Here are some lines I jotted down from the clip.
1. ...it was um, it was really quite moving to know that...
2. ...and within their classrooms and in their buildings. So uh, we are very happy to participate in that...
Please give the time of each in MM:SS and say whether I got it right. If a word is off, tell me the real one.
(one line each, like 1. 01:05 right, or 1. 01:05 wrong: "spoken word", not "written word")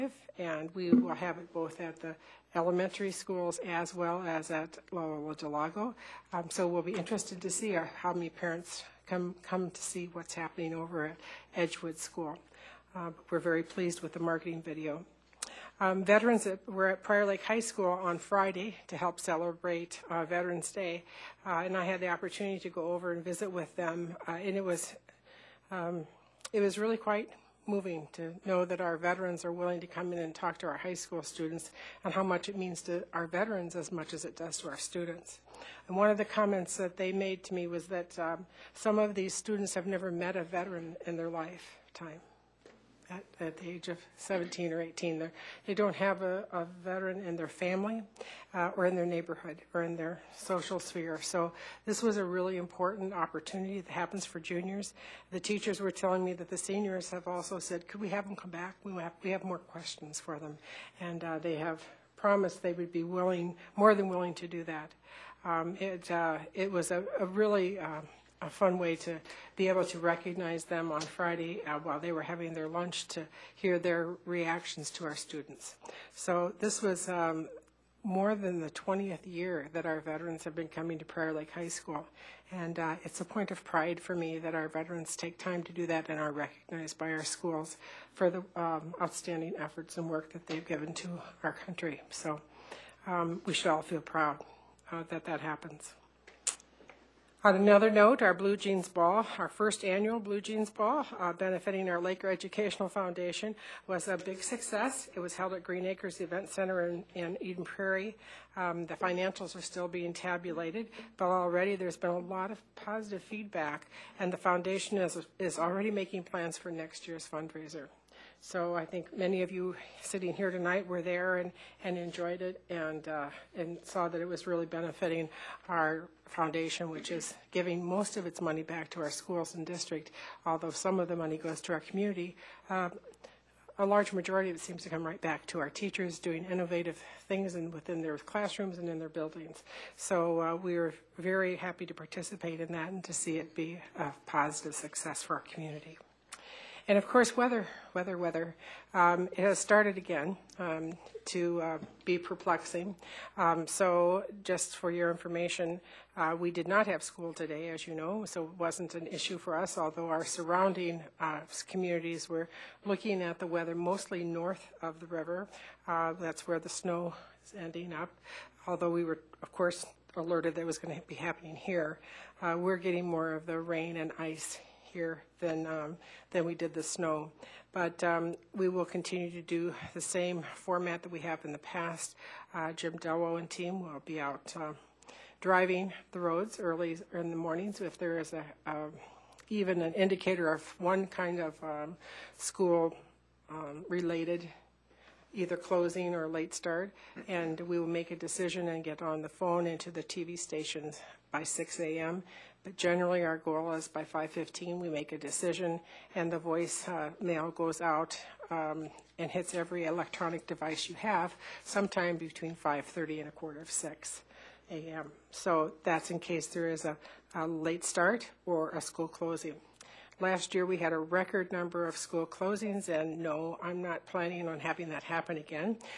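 1. 00:24 right
2. 02:17 right.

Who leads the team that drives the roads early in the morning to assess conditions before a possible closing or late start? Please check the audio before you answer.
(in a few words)
Jim Delwo.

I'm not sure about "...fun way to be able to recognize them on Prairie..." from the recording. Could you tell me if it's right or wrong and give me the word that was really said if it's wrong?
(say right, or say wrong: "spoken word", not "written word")
wrong: "Friday", not "Prairie".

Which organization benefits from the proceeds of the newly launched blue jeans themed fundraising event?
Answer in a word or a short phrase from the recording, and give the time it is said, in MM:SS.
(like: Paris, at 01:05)
Laker Educational Foundation, at 01:42.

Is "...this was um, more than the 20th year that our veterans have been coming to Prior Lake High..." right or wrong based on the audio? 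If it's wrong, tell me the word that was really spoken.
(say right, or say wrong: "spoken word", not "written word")
right.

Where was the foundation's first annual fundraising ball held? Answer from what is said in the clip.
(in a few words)
Green Acres Event Center.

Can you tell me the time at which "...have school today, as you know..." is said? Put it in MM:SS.
02:36.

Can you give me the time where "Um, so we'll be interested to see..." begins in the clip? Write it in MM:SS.
00:06.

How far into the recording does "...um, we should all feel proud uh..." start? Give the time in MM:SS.
01:33.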